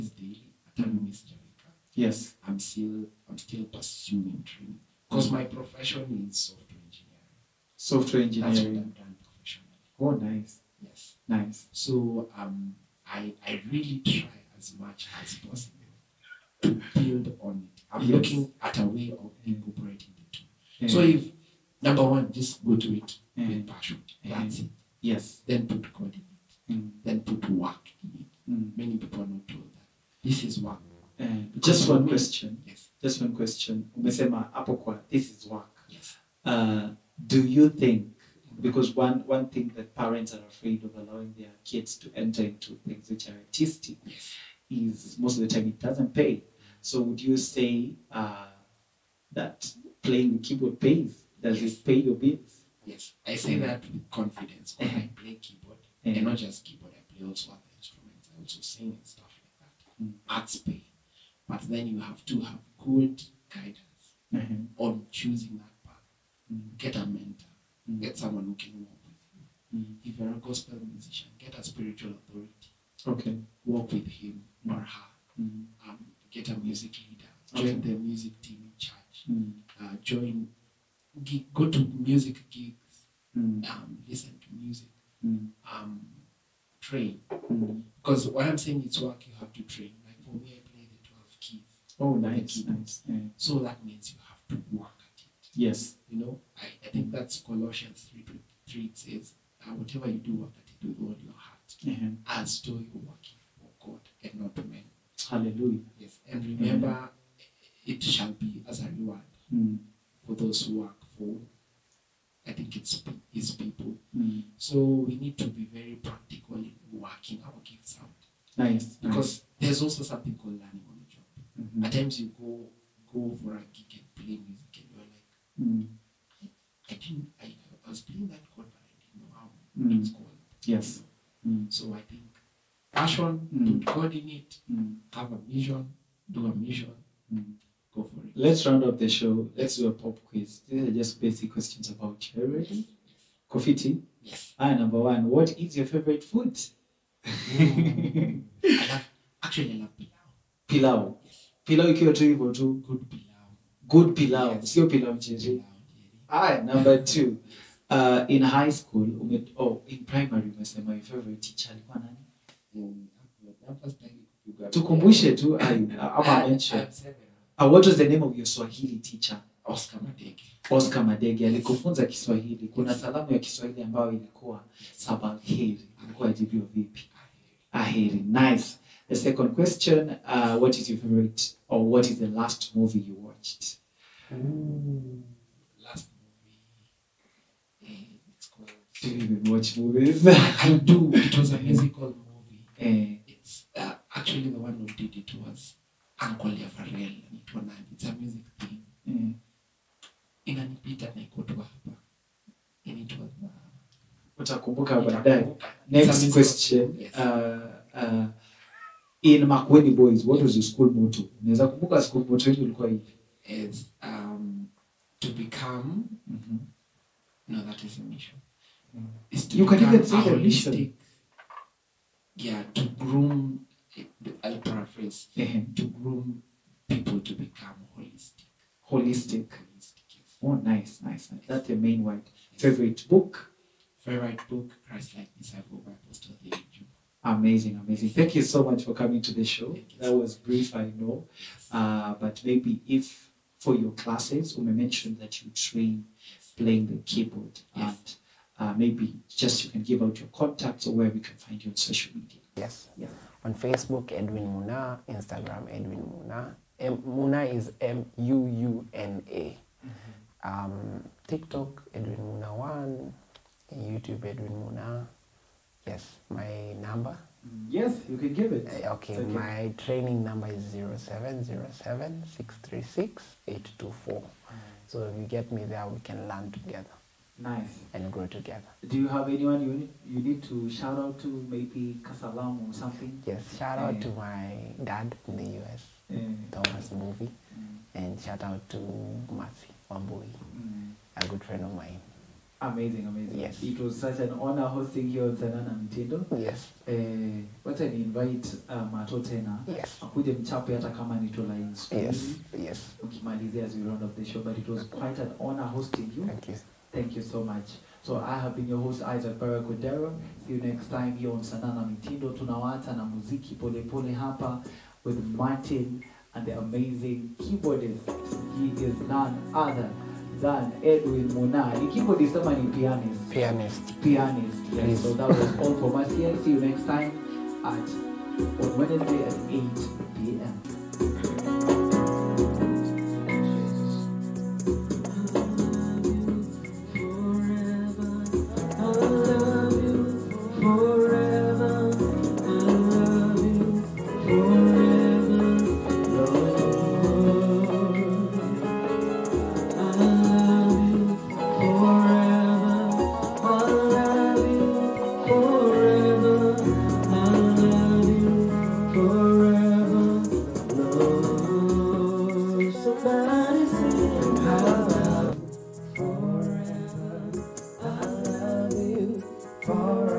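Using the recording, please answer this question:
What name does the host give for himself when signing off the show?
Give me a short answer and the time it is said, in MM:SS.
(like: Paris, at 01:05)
Isaac Barakodero, at 05:09.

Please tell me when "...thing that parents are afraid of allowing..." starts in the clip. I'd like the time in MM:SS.
00:39.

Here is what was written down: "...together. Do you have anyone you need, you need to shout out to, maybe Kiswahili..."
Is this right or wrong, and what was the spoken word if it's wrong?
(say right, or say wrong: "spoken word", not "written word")
wrong: "Kasalam", not "Kiswahili".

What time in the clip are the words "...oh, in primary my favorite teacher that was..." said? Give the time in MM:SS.
02:39.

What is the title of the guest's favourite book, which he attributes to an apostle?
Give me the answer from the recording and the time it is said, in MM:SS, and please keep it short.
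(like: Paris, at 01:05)
Christ Like Disciple, at 03:54.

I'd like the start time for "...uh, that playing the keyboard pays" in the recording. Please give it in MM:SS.
00:48.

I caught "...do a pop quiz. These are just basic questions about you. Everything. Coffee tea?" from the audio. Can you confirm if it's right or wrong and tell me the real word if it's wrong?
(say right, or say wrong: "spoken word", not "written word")
right.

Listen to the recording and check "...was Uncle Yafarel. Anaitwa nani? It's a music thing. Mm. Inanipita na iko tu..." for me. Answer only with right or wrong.
right.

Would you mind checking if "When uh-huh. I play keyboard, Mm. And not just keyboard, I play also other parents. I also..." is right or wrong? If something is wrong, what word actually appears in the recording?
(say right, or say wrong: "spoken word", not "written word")
wrong: "instruments", not "parents".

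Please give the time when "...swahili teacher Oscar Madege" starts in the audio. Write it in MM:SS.
02:48.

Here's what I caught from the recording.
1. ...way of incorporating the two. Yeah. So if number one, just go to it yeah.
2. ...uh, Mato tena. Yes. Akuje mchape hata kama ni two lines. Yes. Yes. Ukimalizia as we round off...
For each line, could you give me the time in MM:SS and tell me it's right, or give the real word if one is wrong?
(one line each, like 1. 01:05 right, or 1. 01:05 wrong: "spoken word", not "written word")
1. 00:18 right
2. 04:58 right.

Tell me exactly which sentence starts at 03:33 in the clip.
Is um, to become mm -hmm.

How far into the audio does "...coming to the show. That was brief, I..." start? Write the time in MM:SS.
03:58.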